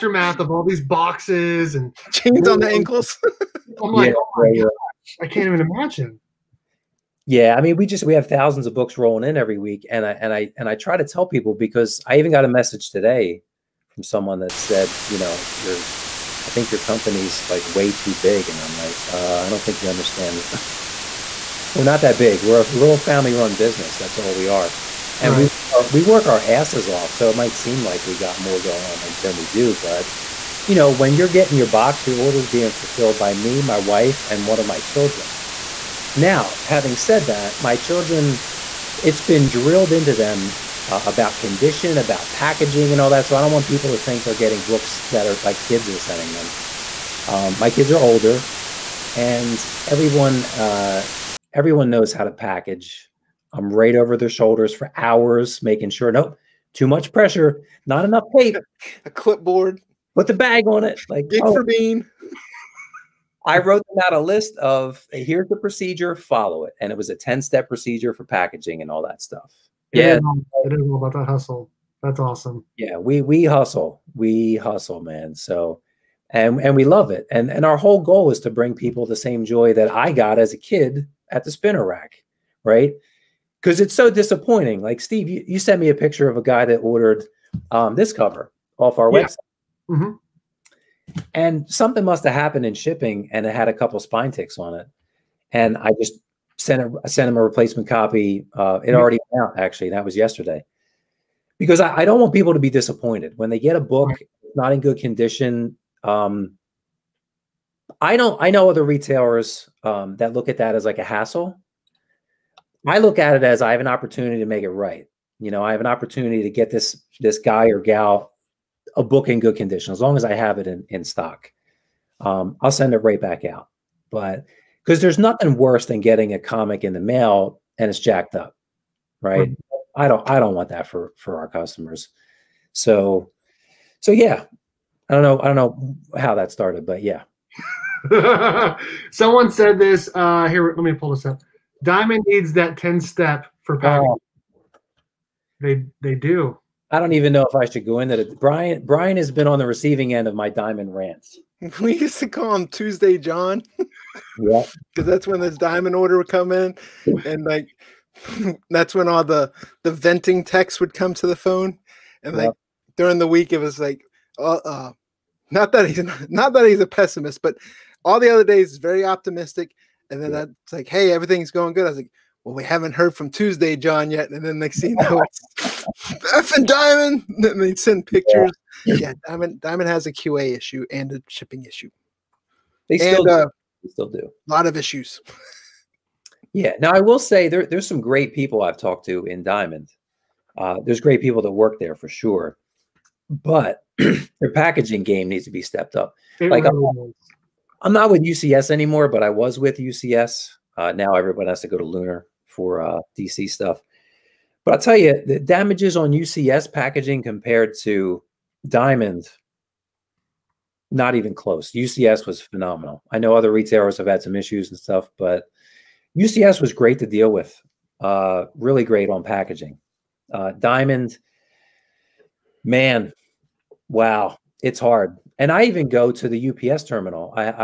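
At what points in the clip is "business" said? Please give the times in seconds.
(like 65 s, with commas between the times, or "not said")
23 s.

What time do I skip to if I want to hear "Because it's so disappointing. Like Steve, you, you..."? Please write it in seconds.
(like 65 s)
83 s.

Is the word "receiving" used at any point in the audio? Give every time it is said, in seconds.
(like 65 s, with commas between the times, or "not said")
149 s.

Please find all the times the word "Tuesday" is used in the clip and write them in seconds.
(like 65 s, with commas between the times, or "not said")
152 s, 173 s.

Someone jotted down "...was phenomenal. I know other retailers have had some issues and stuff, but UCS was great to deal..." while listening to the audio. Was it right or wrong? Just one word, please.
right.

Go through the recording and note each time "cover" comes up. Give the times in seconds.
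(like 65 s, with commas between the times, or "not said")
88 s.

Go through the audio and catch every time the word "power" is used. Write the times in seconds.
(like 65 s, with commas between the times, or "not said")
143 s.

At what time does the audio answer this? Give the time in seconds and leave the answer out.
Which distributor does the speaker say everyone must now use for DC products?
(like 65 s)
201 s.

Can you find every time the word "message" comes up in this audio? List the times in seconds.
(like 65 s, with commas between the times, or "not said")
12 s.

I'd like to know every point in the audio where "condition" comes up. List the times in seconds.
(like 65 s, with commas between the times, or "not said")
41 s, 104 s, 119 s.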